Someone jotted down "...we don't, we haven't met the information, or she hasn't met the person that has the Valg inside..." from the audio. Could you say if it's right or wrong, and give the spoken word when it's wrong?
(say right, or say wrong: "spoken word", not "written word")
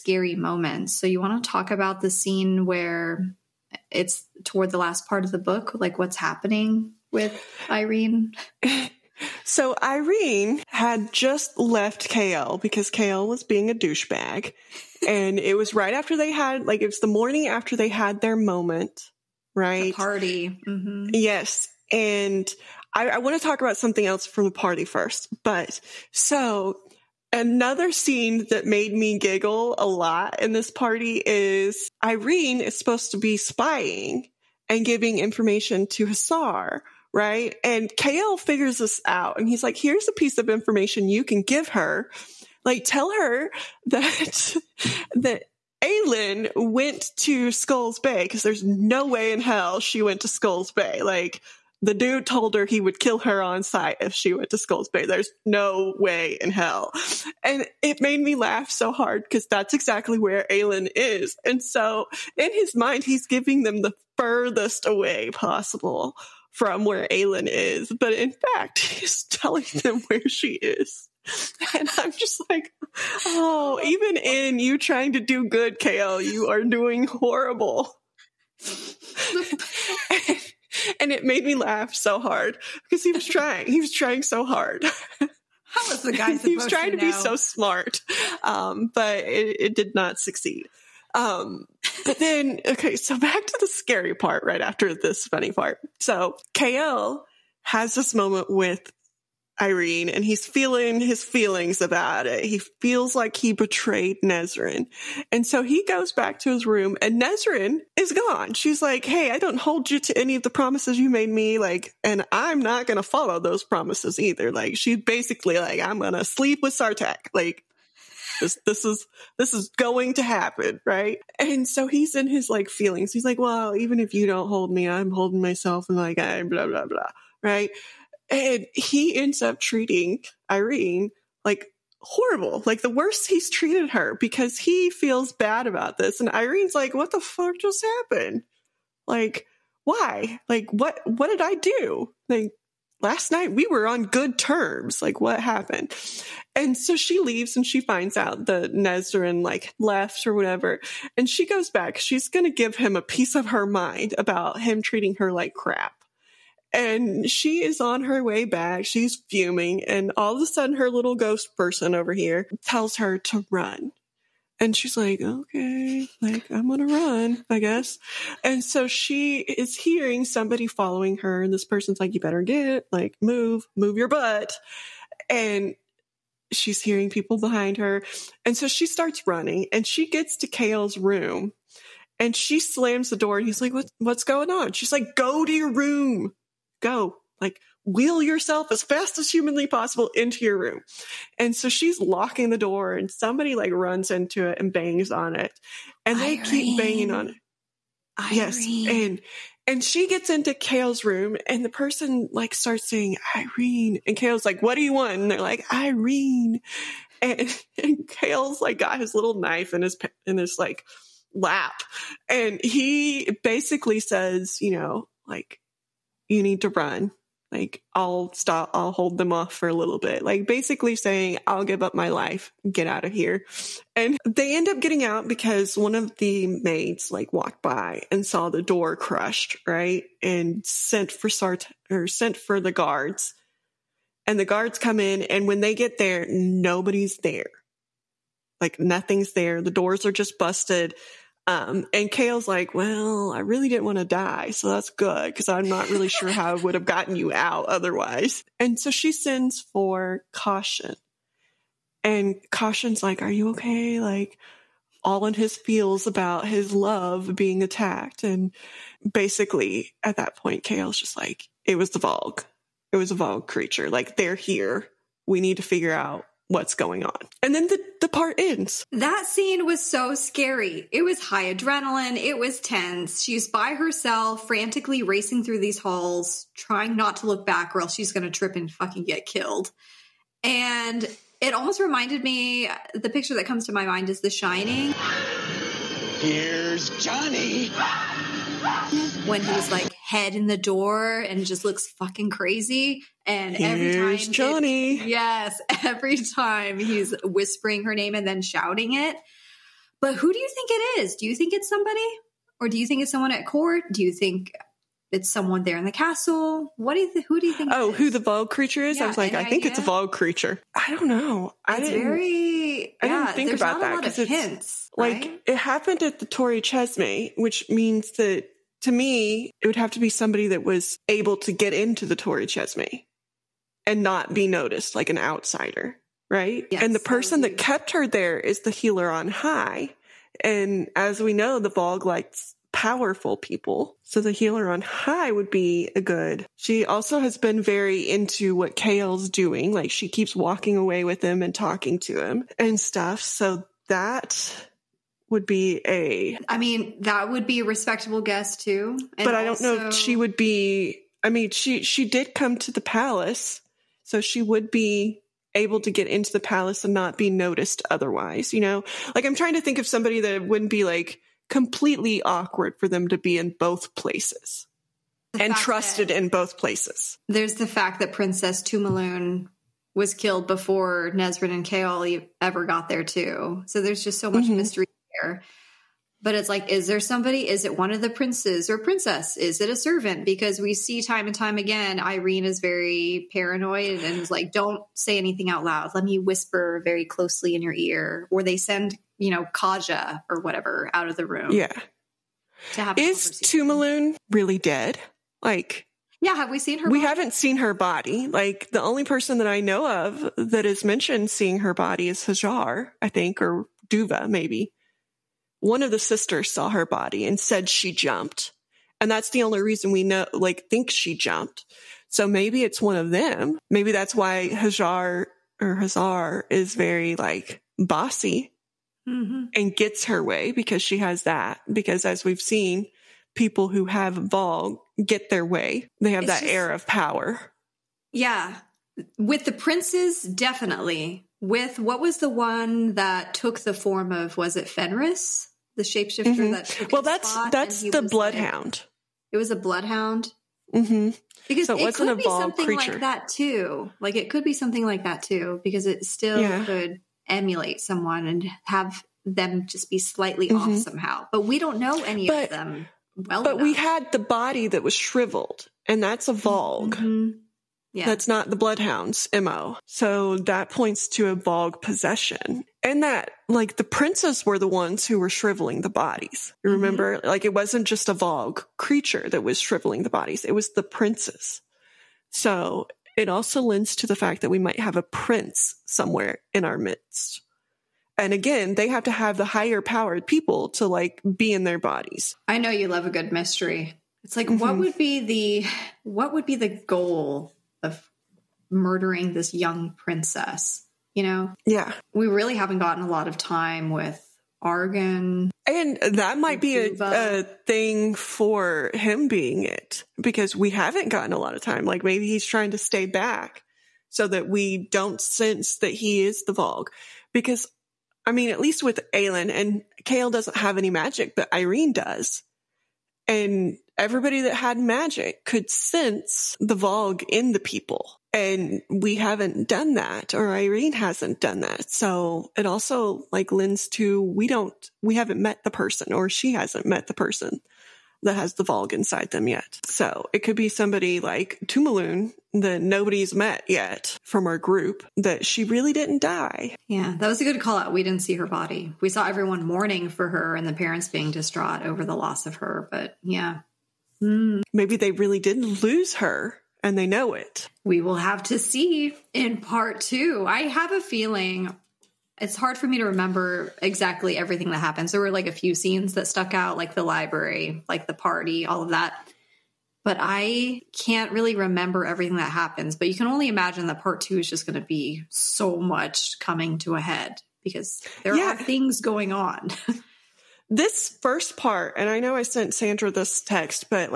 wrong: "person", not "information".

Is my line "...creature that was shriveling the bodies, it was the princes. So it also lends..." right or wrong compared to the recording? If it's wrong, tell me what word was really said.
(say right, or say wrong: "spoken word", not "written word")
right.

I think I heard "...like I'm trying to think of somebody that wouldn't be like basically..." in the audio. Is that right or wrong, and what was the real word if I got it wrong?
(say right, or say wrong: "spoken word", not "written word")
wrong: "completely", not "basically".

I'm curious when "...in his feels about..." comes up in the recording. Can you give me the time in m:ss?
4:15.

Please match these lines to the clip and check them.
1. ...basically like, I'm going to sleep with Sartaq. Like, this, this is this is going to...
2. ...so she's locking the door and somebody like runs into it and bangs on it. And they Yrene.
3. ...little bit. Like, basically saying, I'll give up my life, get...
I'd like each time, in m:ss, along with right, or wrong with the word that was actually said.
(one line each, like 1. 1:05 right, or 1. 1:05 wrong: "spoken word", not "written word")
1. 1:54 right
2. 3:11 right
3. 3:39 right.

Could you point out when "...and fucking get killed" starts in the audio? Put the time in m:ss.
4:38.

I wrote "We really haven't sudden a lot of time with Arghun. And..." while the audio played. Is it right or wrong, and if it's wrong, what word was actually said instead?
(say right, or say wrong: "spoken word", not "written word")
wrong: "gotten", not "sudden".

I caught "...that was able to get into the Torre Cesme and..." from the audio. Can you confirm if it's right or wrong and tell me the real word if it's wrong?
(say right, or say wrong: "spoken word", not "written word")
right.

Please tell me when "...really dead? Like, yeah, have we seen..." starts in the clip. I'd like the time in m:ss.
6:34.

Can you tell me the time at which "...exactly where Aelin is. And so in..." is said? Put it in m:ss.
0:59.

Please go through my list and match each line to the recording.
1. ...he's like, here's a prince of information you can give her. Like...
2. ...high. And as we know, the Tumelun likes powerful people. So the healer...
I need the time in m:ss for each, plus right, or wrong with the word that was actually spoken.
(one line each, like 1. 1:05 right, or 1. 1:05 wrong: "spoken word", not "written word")
1. 0:39 wrong: "piece", not "prince"
2. 5:29 wrong: "Valg", not "Tumelun".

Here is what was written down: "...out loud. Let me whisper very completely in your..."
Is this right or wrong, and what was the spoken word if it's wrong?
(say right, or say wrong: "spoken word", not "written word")
wrong: "closely", not "completely".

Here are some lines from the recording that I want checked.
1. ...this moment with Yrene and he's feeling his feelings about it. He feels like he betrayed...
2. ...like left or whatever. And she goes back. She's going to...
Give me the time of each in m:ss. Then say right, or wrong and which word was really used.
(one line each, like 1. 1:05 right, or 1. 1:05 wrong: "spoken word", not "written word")
1. 1:37 right
2. 2:29 right.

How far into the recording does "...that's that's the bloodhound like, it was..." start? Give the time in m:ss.
7:17.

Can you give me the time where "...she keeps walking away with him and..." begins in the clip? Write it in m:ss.
5:39.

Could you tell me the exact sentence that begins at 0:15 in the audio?
and it was right after they had, like, it was the morning after they had their moment right?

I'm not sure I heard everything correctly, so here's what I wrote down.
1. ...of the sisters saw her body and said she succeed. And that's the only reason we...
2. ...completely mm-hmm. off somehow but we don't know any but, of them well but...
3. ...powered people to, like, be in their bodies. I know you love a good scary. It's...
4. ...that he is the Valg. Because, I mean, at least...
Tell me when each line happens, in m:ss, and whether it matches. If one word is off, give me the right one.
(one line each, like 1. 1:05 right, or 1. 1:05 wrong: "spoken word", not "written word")
1. 6:45 wrong: "jumped", not "succeed"
2. 7:29 wrong: "slightly", not "completely"
3. 7:59 wrong: "mystery", not "scary"
4. 8:25 right.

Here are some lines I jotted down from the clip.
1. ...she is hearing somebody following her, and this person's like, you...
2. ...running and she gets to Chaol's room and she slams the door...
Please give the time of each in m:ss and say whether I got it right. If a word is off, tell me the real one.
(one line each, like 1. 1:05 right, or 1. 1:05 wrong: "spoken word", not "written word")
1. 2:48 right
2. 2:59 right.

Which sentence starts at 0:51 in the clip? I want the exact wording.
Like the dude told her he would kill her on sight if she went to Skull's Bay.